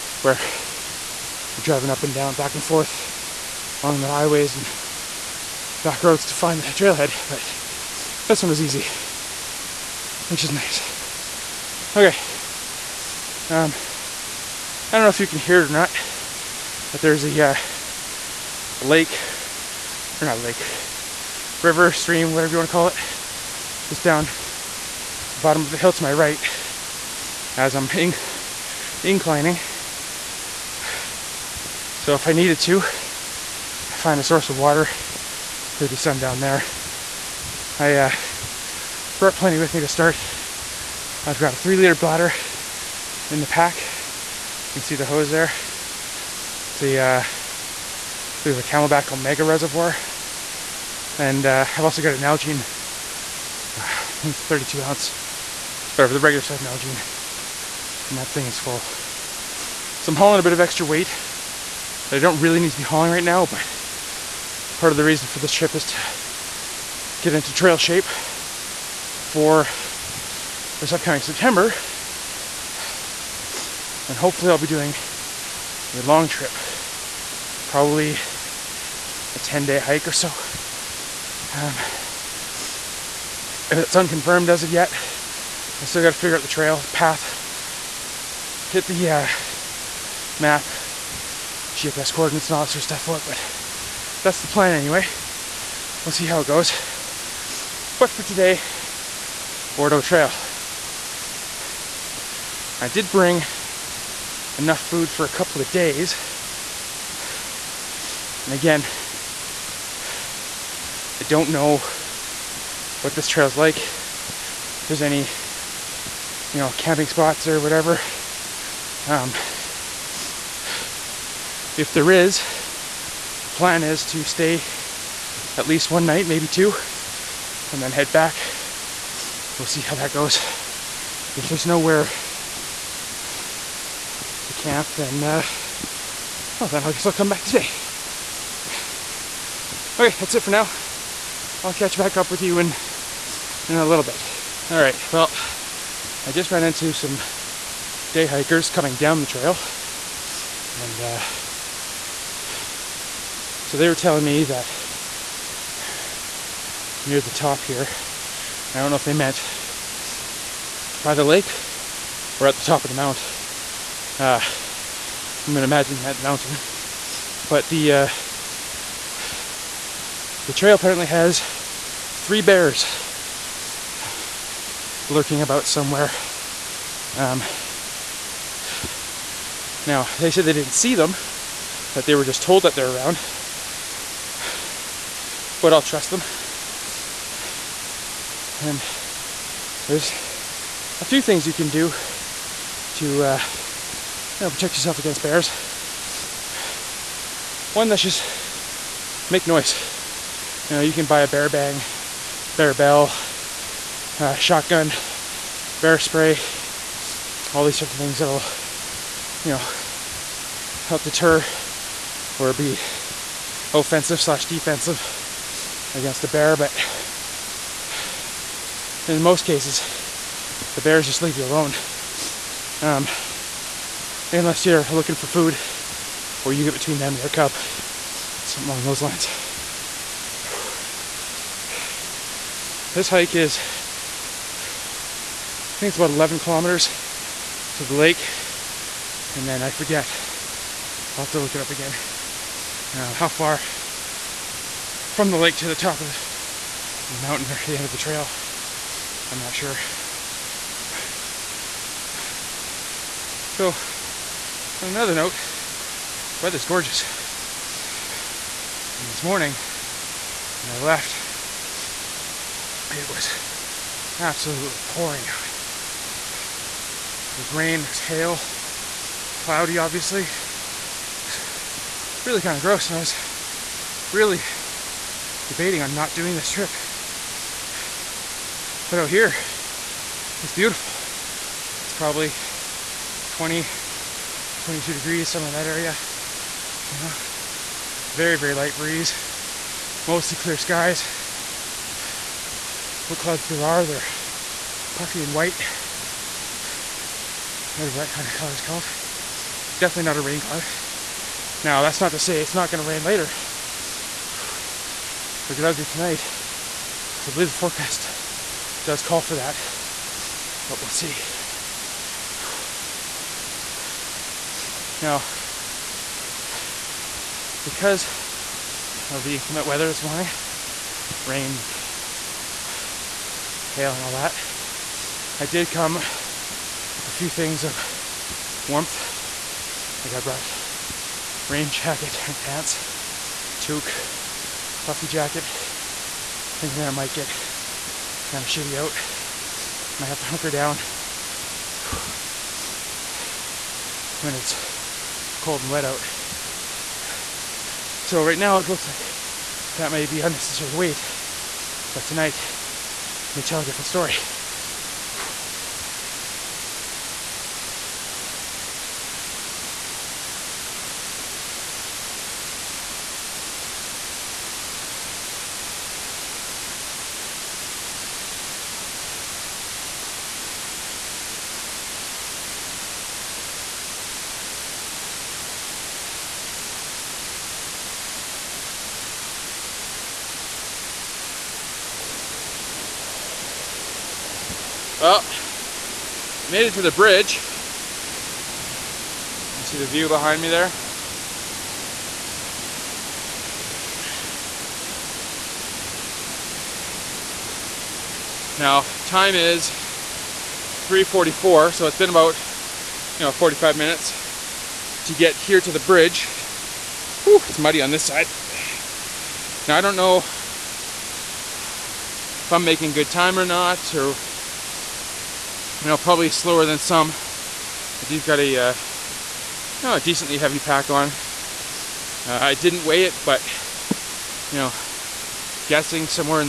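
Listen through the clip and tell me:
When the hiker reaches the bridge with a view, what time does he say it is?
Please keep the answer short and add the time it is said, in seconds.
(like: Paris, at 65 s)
3:44, at 400 s.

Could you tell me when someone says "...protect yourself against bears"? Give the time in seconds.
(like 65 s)
194 s.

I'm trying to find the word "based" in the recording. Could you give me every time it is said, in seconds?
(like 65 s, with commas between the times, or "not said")
not said.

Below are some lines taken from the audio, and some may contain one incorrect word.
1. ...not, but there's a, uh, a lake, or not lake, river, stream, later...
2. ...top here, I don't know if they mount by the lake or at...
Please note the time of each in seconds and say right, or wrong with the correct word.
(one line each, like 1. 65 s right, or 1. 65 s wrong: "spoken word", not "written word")
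1. 15 s wrong: "whatever", not "later"
2. 157 s wrong: "meant", not "mount".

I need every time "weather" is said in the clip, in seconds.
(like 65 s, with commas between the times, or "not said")
256 s, 319 s.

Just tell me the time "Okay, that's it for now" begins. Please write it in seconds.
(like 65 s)
139 s.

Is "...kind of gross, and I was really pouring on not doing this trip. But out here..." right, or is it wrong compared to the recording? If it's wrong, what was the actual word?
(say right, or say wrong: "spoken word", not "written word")
wrong: "debating", not "pouring".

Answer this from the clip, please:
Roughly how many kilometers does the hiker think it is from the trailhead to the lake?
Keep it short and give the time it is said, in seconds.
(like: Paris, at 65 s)
11, at 236 s.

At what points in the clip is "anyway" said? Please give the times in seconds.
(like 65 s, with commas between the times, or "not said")
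94 s.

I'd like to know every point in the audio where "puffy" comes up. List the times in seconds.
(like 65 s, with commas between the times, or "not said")
294 s, 334 s.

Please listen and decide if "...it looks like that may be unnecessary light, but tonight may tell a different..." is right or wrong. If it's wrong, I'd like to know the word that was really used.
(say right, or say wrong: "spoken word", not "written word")
wrong: "weight", not "light".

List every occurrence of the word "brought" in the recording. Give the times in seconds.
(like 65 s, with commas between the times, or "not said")
39 s, 330 s.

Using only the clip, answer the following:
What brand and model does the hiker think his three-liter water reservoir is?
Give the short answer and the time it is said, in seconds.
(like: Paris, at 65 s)
CamelBak Omega, at 48 s.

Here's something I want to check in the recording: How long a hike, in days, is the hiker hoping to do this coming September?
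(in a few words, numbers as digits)
10.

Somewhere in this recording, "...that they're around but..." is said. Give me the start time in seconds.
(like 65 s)
182 s.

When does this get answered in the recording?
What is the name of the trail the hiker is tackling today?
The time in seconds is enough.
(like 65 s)
99 s.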